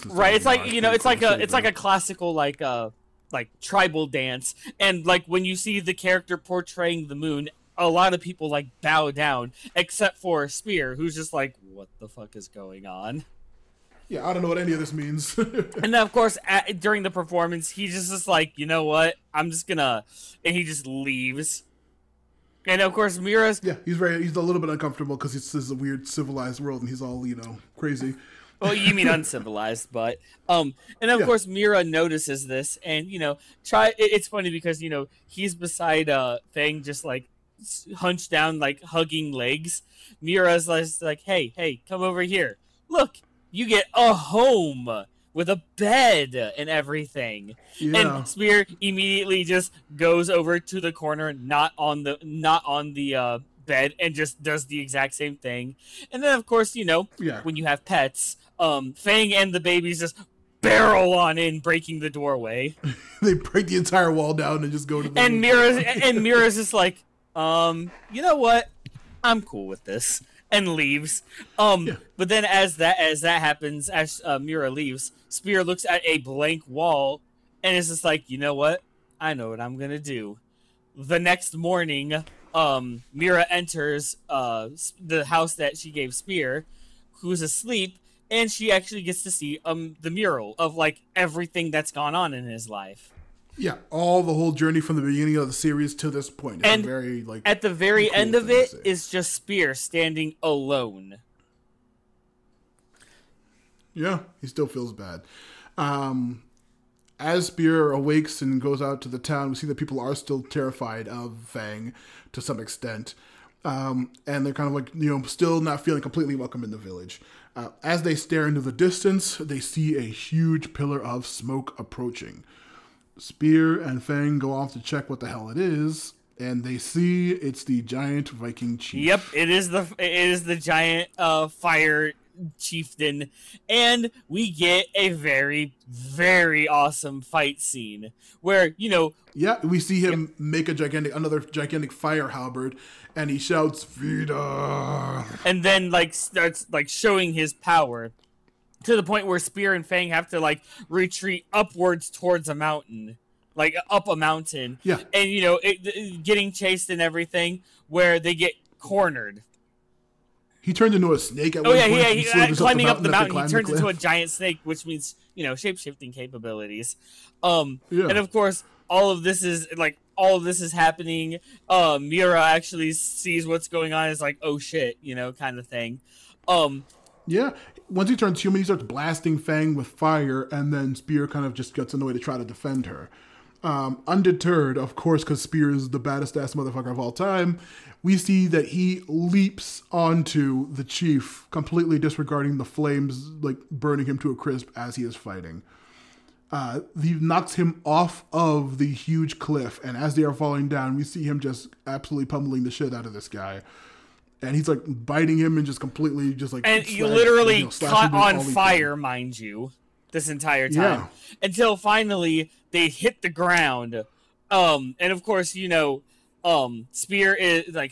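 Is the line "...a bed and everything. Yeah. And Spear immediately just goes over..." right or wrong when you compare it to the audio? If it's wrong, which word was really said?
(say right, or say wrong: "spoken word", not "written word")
right.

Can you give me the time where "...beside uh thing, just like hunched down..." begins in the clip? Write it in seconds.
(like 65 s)
35 s.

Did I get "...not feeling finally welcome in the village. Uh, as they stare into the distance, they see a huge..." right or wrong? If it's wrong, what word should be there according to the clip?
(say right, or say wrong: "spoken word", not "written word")
wrong: "completely", not "finally".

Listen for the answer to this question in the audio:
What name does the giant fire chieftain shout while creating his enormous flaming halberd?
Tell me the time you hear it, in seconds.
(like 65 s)
143 s.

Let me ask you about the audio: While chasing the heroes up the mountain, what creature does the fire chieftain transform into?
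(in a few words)
A giant snake.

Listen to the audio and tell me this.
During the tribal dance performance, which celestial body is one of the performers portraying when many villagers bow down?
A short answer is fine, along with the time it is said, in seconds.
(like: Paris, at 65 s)
The moon, at 7 s.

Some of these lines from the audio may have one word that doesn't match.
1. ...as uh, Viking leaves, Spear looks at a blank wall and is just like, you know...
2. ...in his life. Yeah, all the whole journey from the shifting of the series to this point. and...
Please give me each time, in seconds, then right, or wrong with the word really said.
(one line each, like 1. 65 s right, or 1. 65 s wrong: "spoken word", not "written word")
1. 73 s wrong: "Mira", not "Viking"
2. 92 s wrong: "beginning", not "shifting".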